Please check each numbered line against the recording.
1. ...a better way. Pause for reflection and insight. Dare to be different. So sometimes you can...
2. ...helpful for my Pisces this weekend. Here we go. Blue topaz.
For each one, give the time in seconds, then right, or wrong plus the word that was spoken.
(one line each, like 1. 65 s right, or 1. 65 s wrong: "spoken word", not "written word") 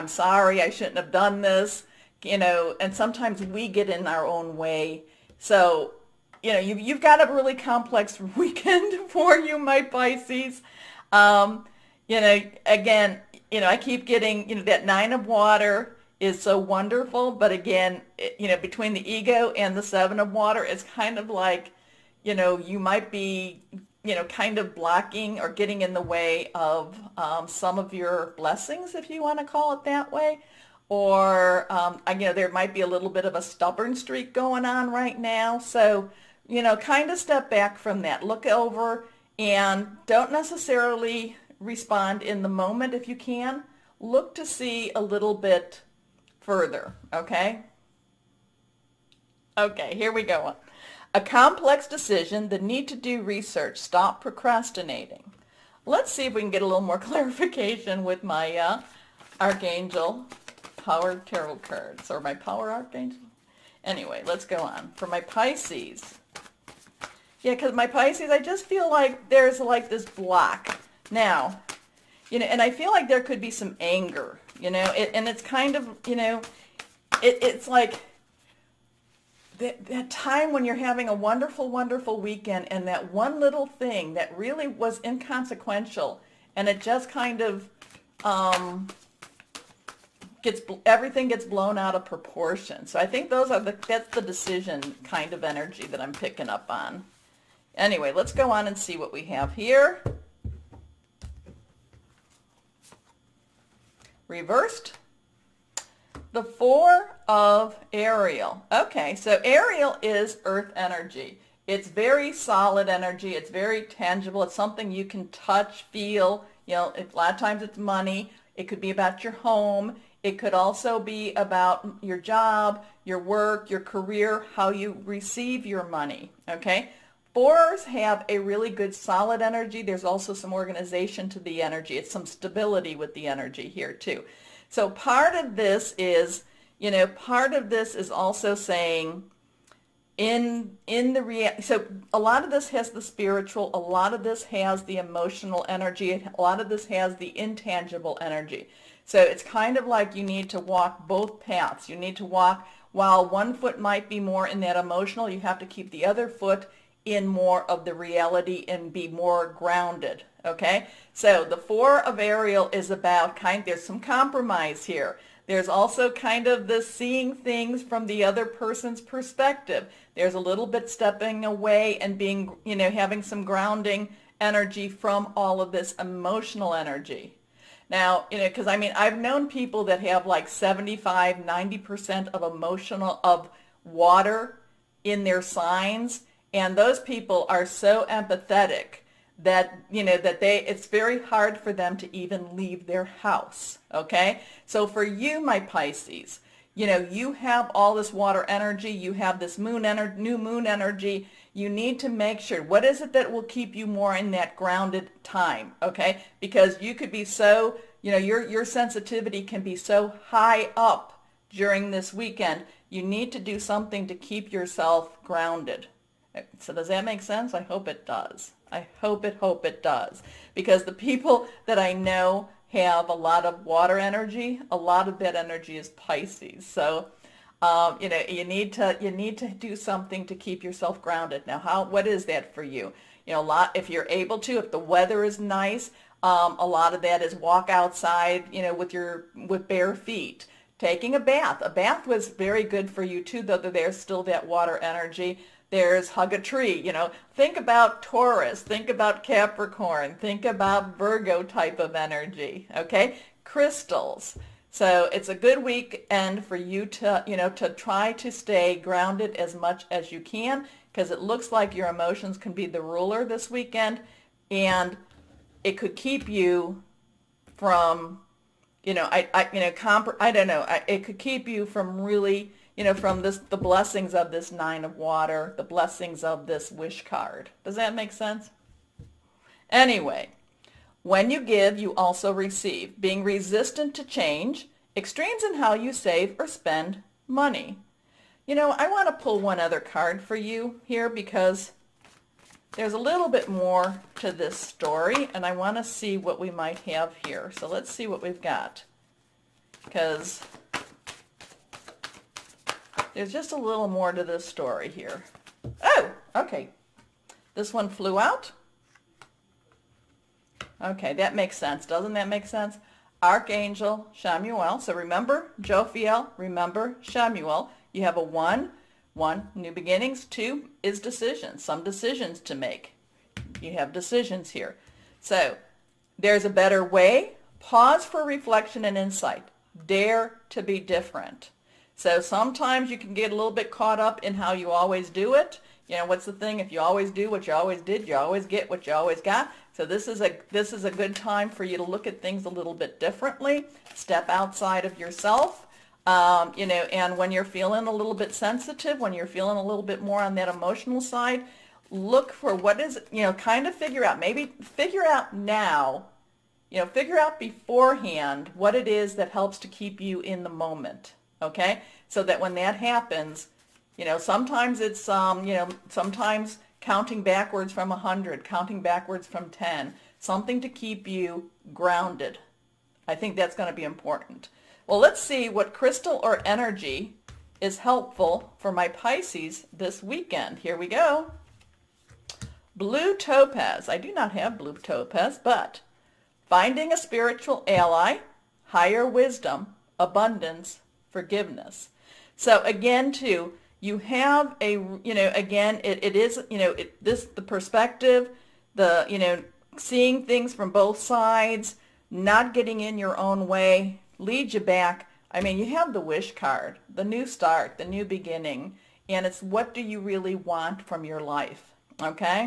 1. 326 s right
2. 377 s right.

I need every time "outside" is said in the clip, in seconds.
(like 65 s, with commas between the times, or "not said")
237 s, 344 s.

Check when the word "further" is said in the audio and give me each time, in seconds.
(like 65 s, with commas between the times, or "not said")
46 s.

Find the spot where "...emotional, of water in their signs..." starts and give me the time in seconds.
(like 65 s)
182 s.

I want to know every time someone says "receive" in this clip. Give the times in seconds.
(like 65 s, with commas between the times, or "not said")
125 s, 282 s.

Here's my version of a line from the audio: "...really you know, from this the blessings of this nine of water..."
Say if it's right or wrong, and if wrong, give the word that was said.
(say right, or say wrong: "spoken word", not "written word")
right.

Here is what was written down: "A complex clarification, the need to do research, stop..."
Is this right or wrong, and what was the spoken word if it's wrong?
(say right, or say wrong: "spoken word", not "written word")
wrong: "decision", not "clarification".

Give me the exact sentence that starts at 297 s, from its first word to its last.
So let's see what we've got because there's just a little more to this story here.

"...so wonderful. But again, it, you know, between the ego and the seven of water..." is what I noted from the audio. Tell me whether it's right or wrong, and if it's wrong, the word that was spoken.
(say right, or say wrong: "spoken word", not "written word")
right.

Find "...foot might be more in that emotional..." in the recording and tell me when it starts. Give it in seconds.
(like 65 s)
153 s.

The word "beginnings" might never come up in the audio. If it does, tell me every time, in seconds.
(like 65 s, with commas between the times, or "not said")
319 s, 408 s.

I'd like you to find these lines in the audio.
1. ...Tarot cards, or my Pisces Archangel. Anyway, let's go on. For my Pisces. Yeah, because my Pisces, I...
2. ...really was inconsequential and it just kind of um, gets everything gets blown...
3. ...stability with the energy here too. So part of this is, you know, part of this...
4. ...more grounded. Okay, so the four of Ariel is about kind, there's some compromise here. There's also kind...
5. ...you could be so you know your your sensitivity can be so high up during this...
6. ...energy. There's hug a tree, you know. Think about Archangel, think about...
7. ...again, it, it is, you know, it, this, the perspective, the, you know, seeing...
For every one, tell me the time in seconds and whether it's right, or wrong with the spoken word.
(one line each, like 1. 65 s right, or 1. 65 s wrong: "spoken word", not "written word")
1. 61 s wrong: "Power", not "Pisces"
2. 84 s right
3. 132 s right
4. 159 s right
5. 206 s right
6. 244 s wrong: "Taurus", not "Archangel"
7. 395 s right.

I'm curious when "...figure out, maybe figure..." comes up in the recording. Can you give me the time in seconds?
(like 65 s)
353 s.